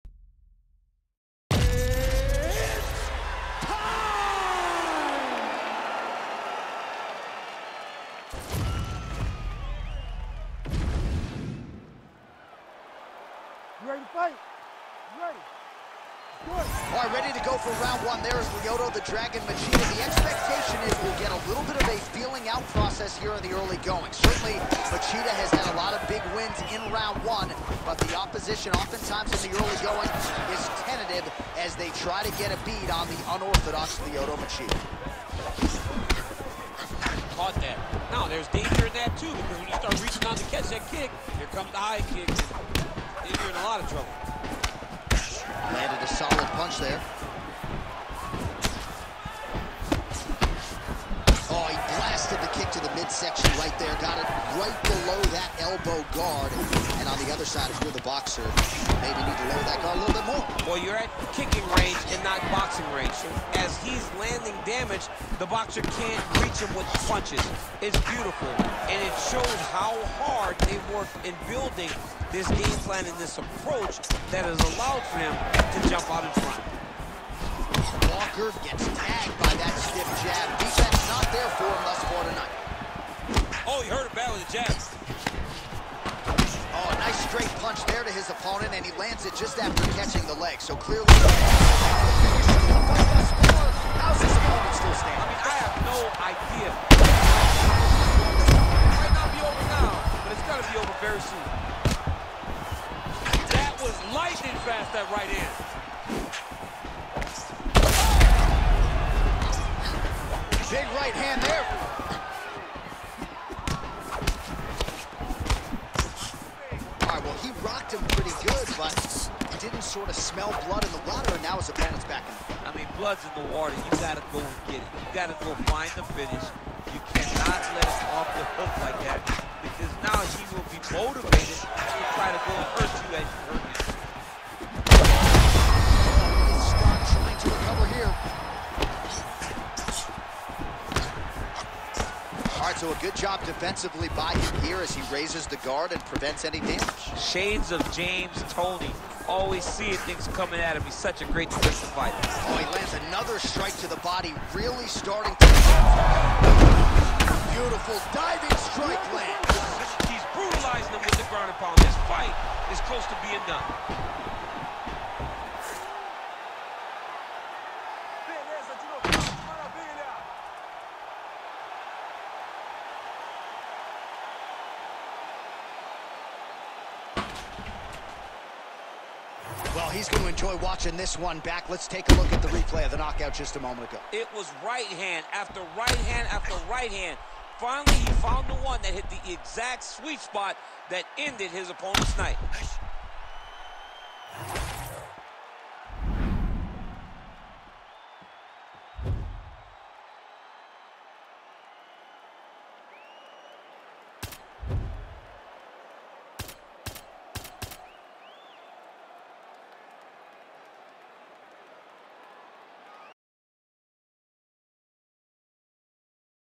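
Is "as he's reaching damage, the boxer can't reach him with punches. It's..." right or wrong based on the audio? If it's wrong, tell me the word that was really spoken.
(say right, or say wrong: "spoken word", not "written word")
wrong: "landing", not "reaching".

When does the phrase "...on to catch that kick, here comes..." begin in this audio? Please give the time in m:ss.
0:40.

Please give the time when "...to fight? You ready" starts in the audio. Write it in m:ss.
0:14.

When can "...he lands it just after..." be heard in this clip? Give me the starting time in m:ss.
1:28.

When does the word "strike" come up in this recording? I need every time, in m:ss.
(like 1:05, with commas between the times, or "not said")
2:33, 2:38.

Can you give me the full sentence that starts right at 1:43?
That was lightning fast, that right hand.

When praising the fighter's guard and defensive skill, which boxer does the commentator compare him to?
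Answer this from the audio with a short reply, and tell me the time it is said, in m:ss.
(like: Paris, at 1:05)
James Toney, at 2:27.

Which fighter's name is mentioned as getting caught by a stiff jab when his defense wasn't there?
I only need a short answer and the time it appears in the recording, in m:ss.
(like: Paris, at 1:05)
Walker, at 1:18.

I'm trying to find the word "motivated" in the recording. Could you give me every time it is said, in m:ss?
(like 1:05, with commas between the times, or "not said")
2:10.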